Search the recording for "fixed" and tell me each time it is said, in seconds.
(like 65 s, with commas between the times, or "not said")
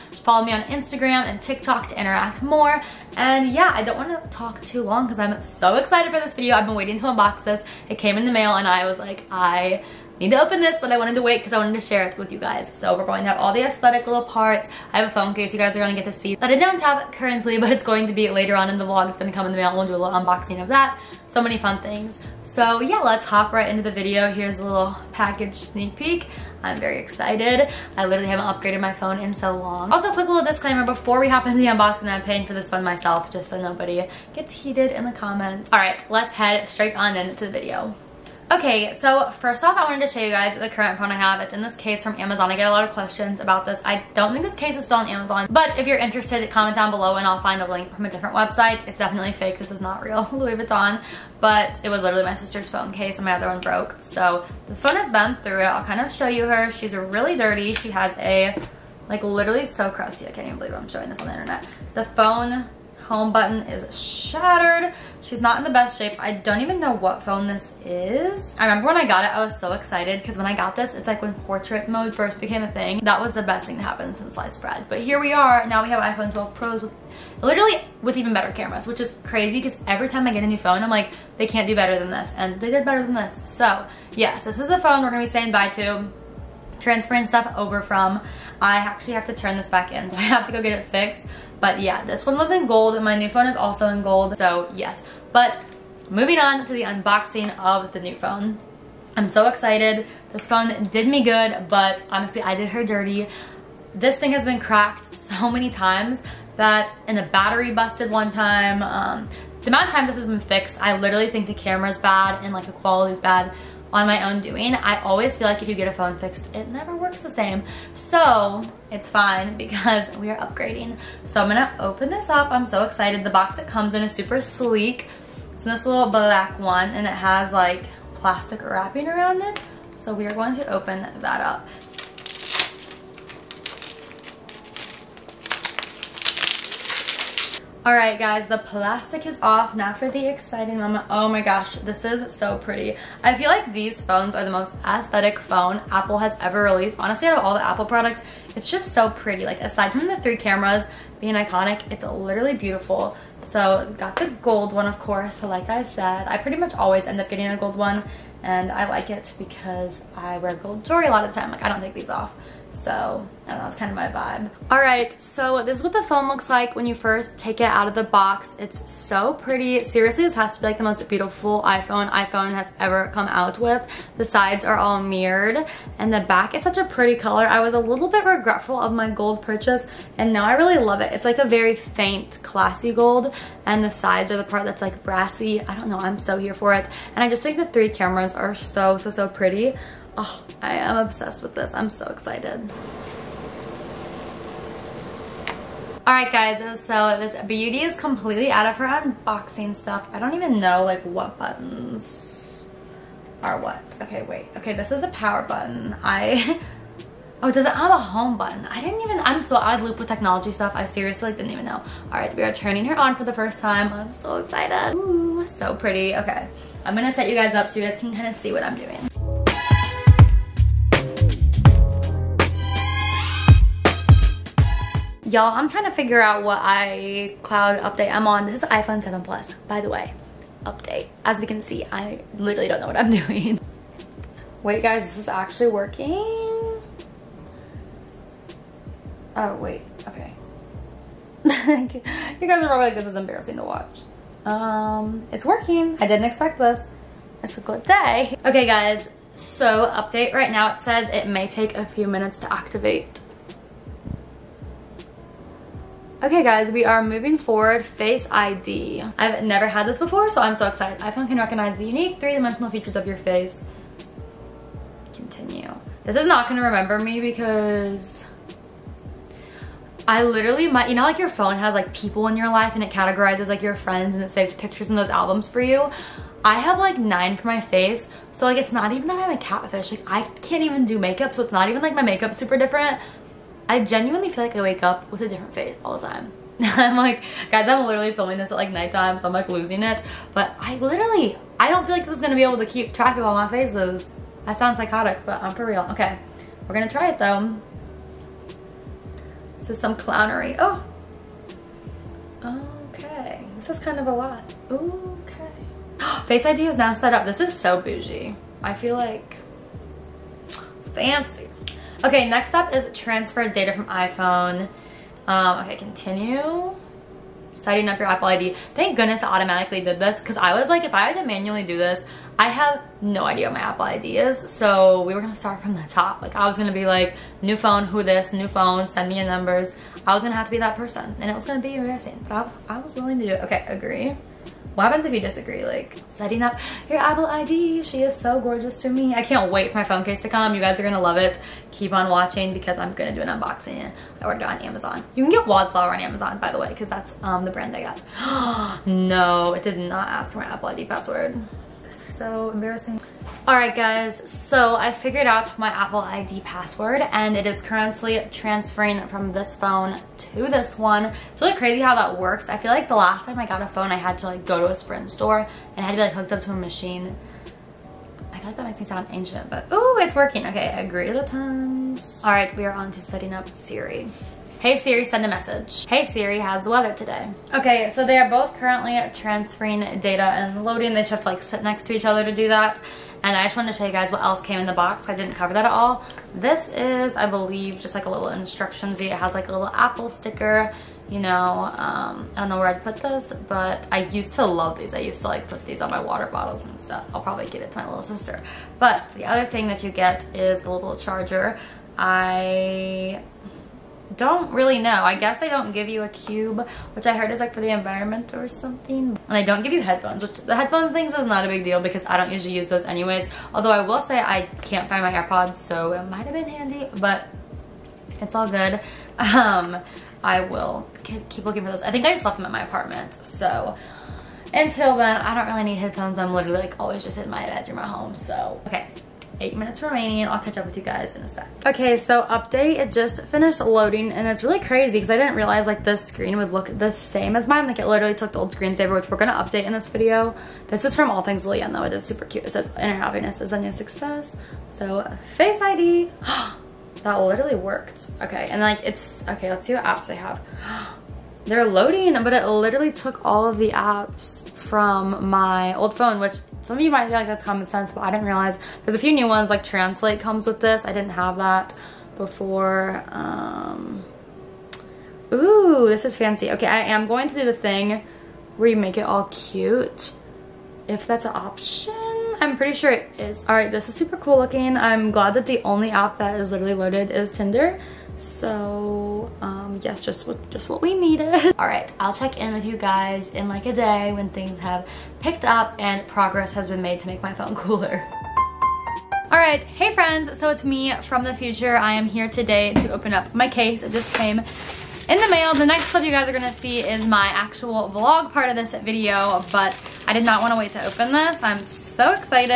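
90 s, 110 s, 116 s.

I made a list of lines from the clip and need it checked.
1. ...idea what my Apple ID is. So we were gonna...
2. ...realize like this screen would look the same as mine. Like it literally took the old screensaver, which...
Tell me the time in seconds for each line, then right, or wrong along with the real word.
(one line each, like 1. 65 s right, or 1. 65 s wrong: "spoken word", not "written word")
1. 323 s right
2. 435 s right.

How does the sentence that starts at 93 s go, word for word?
My new phone is also in gold.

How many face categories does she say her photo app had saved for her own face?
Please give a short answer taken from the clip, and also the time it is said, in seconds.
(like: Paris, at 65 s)
9, at 276 s.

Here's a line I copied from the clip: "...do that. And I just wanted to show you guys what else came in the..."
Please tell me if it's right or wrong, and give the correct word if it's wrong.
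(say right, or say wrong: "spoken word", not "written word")
right.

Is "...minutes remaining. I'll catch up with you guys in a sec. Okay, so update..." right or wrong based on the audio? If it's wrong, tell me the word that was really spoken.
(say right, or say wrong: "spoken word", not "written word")
right.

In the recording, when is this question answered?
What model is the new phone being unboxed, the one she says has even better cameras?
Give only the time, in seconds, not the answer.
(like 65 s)
76 s.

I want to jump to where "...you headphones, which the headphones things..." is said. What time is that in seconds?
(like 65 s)
409 s.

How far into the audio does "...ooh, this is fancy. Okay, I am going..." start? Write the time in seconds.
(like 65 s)
465 s.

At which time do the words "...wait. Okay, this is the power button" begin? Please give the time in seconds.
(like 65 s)
204 s.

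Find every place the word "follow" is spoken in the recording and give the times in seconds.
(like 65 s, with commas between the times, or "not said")
0 s.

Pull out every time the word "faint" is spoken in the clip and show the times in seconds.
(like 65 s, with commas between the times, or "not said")
181 s.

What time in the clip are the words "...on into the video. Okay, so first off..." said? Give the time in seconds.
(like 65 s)
36 s.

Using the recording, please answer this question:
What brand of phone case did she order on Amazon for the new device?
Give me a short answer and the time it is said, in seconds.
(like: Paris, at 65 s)
Wildflower, at 345 s.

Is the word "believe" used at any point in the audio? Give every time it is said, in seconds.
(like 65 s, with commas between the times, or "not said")
60 s, 387 s.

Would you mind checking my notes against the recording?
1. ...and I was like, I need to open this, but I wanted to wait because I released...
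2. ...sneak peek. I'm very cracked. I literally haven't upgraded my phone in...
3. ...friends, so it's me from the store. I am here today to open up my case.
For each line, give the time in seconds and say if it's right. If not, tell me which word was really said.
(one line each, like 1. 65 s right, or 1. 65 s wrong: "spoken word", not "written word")
1. 8 s wrong: "wanted", not "released"
2. 25 s wrong: "excited", not "cracked"
3. 489 s wrong: "future", not "store".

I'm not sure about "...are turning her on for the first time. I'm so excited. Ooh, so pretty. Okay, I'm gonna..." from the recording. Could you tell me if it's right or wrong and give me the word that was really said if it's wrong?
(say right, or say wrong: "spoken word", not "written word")
right.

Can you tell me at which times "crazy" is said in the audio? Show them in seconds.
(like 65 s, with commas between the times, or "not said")
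79 s, 361 s, 434 s.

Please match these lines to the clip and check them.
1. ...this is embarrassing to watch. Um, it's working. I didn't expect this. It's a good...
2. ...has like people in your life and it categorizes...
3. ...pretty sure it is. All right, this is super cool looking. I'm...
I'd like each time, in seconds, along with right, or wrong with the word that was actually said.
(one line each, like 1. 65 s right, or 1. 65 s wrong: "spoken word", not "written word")
1. 242 s right
2. 271 s right
3. 472 s right.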